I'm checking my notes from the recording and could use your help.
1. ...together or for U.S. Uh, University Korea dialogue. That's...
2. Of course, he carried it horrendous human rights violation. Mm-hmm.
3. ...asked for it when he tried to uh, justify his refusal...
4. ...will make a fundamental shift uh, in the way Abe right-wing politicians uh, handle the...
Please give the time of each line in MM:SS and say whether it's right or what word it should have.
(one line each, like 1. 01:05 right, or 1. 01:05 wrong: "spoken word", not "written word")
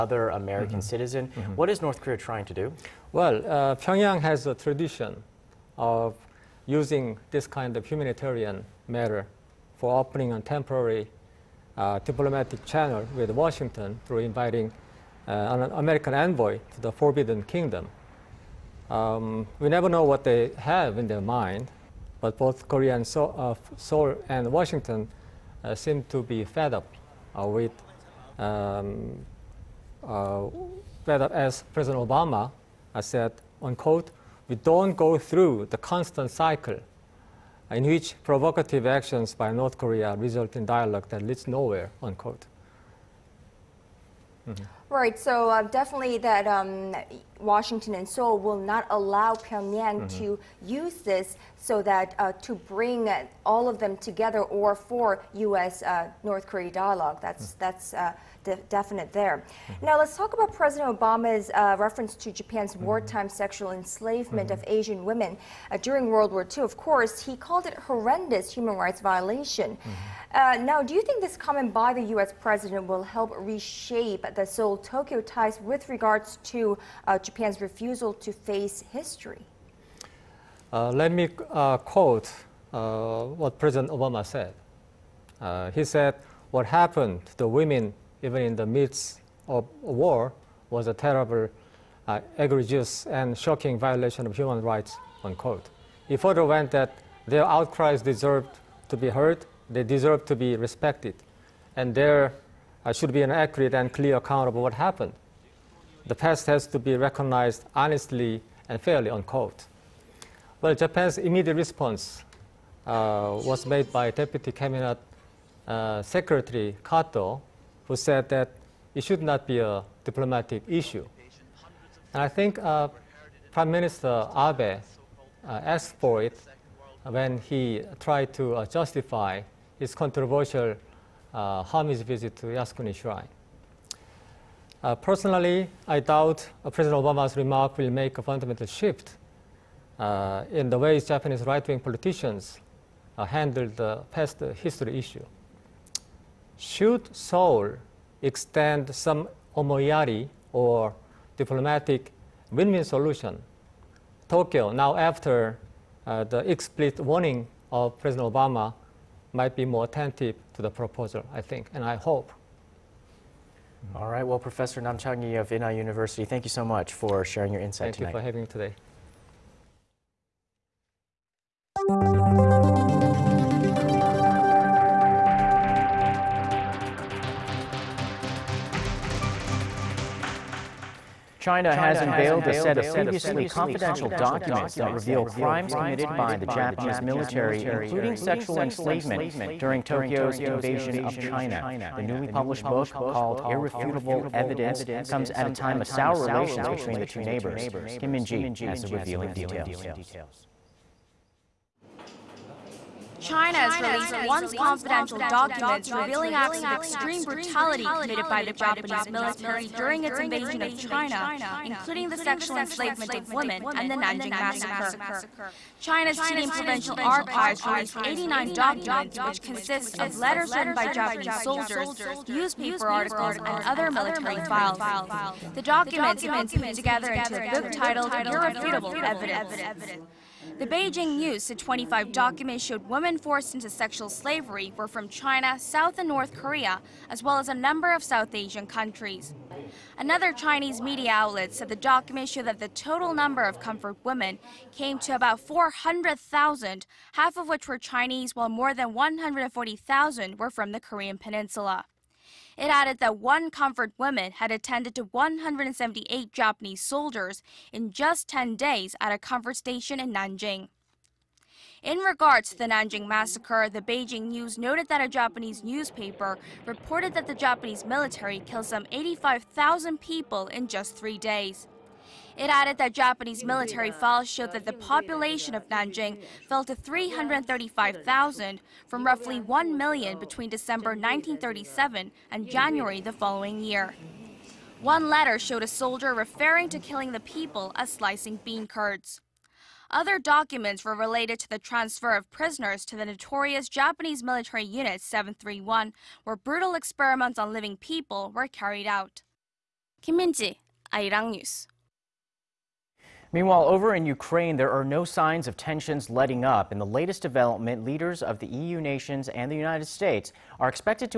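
1. 00:54 wrong: "North", not "University"
2. 01:06 wrong: "called", not "carried"
3. 02:05 wrong: "controversial", not "refusal"
4. 02:17 wrong: "Japanese", not "Abe".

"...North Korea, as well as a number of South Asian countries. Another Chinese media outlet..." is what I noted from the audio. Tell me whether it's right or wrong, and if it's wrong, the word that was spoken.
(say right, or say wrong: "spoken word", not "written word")
right.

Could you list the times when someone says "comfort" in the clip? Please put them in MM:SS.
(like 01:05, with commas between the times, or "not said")
04:03, 04:13, 04:19.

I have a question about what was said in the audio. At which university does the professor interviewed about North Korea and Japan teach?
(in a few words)
Inha University.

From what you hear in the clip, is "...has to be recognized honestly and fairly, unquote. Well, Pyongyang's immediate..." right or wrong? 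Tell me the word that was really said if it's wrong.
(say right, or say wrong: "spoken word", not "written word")
wrong: "Japan", not "Pyongyang".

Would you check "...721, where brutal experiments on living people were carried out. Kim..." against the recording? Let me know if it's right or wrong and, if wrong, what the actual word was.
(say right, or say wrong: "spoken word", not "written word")
wrong: "731", not "721".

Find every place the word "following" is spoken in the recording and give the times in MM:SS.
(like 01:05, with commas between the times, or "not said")
04:43.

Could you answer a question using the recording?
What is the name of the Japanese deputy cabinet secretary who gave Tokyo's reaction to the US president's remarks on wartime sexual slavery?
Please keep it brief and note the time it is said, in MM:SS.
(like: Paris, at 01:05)
Kato, at 01:56.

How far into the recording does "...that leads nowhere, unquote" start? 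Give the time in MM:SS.
00:41.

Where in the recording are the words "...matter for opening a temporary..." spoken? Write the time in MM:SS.
00:08.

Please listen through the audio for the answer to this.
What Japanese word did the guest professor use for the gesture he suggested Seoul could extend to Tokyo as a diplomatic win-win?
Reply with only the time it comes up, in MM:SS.
02:29.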